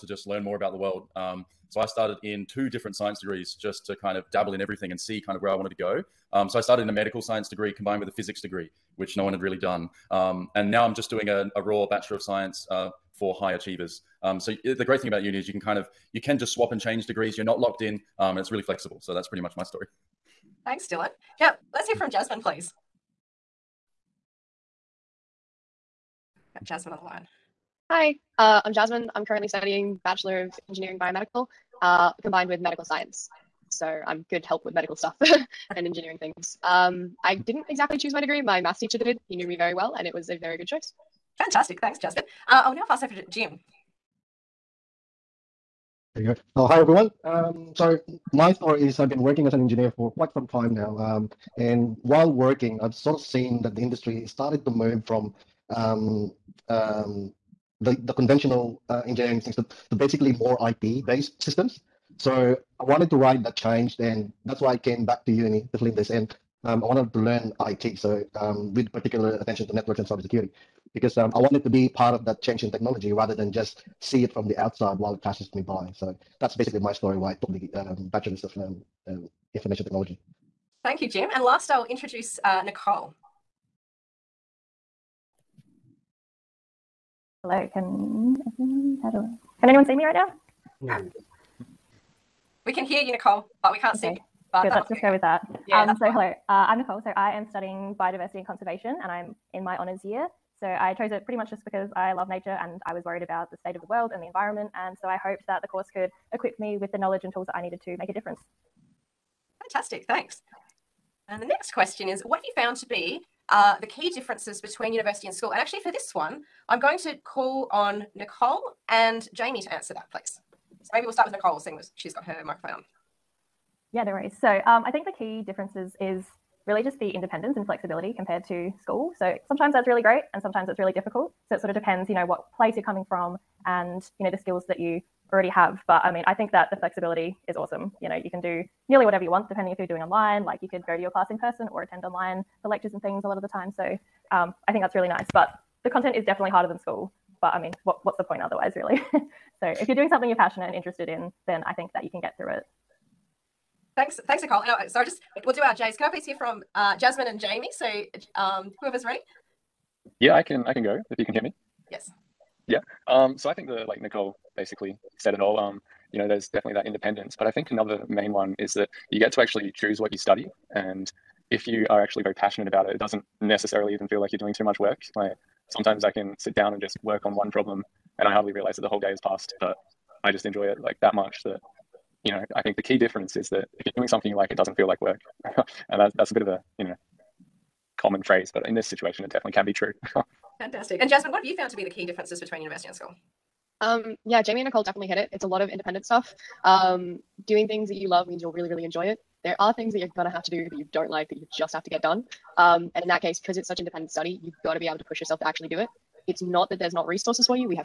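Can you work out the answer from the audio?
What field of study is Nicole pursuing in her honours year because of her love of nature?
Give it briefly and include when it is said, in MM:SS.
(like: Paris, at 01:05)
Biodiversity and conservation, at 01:38.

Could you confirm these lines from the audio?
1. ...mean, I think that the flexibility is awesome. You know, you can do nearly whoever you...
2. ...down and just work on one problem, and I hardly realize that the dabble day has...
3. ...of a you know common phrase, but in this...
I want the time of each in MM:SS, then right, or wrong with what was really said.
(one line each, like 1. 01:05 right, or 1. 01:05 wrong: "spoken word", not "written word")
1. 02:16 wrong: "whatever", not "whoever"
2. 02:56 wrong: "whole", not "dabble"
3. 03:06 right.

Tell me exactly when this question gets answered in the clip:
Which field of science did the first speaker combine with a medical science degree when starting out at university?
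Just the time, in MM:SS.
00:08.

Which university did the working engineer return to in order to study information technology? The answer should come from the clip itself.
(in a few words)
Flinders.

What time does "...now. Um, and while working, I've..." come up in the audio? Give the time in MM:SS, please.
00:50.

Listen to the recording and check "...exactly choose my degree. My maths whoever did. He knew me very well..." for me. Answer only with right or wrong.
wrong.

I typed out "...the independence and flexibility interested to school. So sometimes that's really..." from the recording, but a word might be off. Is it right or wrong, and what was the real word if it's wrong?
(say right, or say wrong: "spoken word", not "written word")
wrong: "compared", not "interested".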